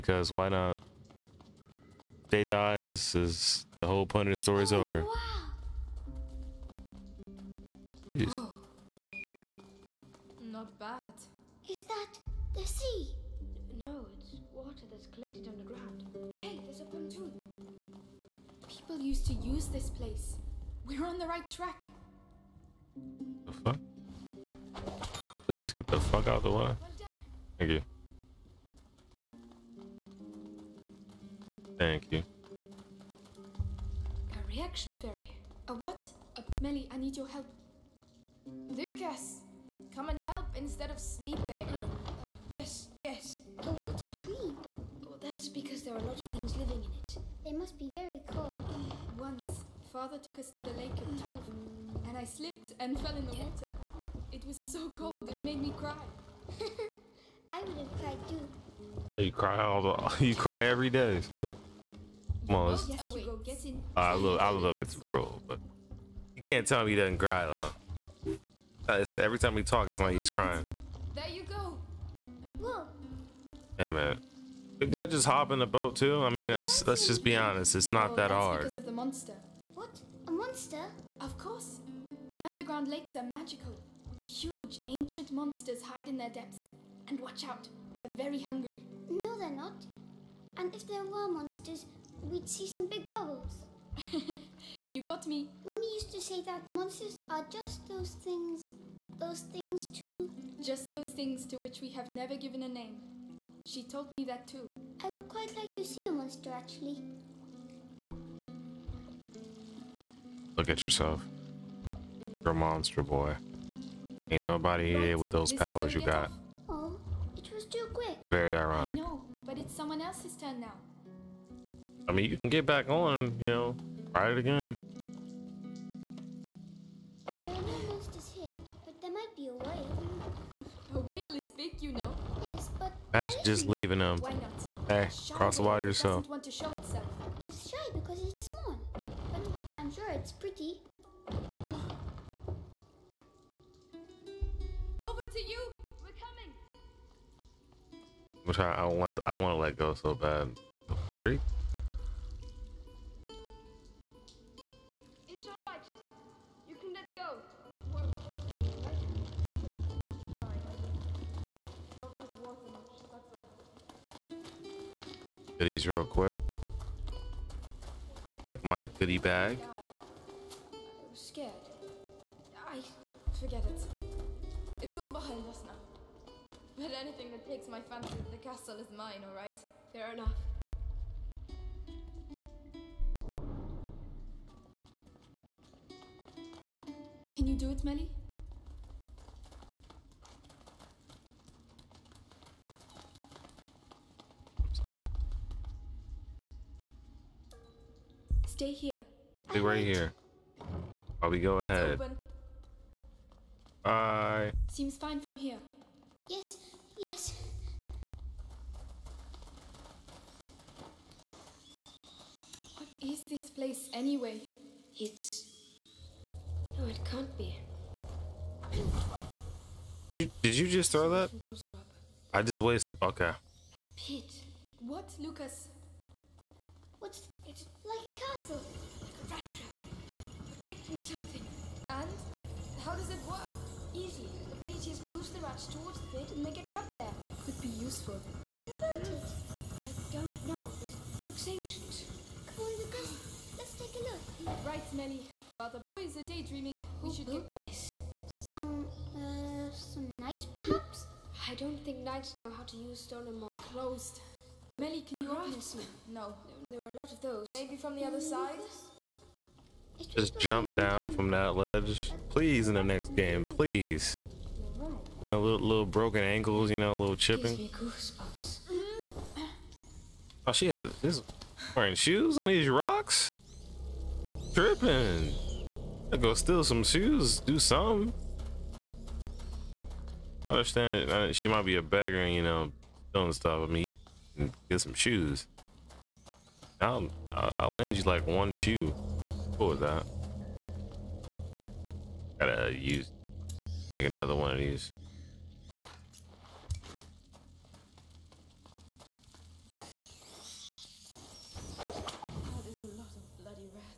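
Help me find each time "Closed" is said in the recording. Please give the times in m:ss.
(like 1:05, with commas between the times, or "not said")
4:13.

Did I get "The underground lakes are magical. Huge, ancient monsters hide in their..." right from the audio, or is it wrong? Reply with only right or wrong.
right.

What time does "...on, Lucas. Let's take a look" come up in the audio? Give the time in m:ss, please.
4:02.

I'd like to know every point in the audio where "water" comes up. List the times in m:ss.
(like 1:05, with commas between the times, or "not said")
0:43, 0:53, 2:15.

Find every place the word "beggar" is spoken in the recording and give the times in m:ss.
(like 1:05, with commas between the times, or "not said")
4:41.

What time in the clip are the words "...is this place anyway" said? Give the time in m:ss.
3:33.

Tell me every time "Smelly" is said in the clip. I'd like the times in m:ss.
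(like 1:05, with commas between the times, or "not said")
4:04.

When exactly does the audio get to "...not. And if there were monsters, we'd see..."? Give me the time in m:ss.
1:29.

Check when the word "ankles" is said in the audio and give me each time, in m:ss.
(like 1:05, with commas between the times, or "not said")
4:26.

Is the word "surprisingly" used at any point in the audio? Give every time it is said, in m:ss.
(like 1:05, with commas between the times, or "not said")
not said.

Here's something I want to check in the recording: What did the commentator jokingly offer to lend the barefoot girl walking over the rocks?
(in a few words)
one shoe.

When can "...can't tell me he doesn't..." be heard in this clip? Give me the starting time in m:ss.
1:06.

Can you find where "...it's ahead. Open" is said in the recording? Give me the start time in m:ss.
3:21.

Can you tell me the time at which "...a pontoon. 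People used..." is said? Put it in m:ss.
0:16.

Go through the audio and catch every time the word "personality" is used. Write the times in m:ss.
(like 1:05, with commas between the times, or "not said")
not said.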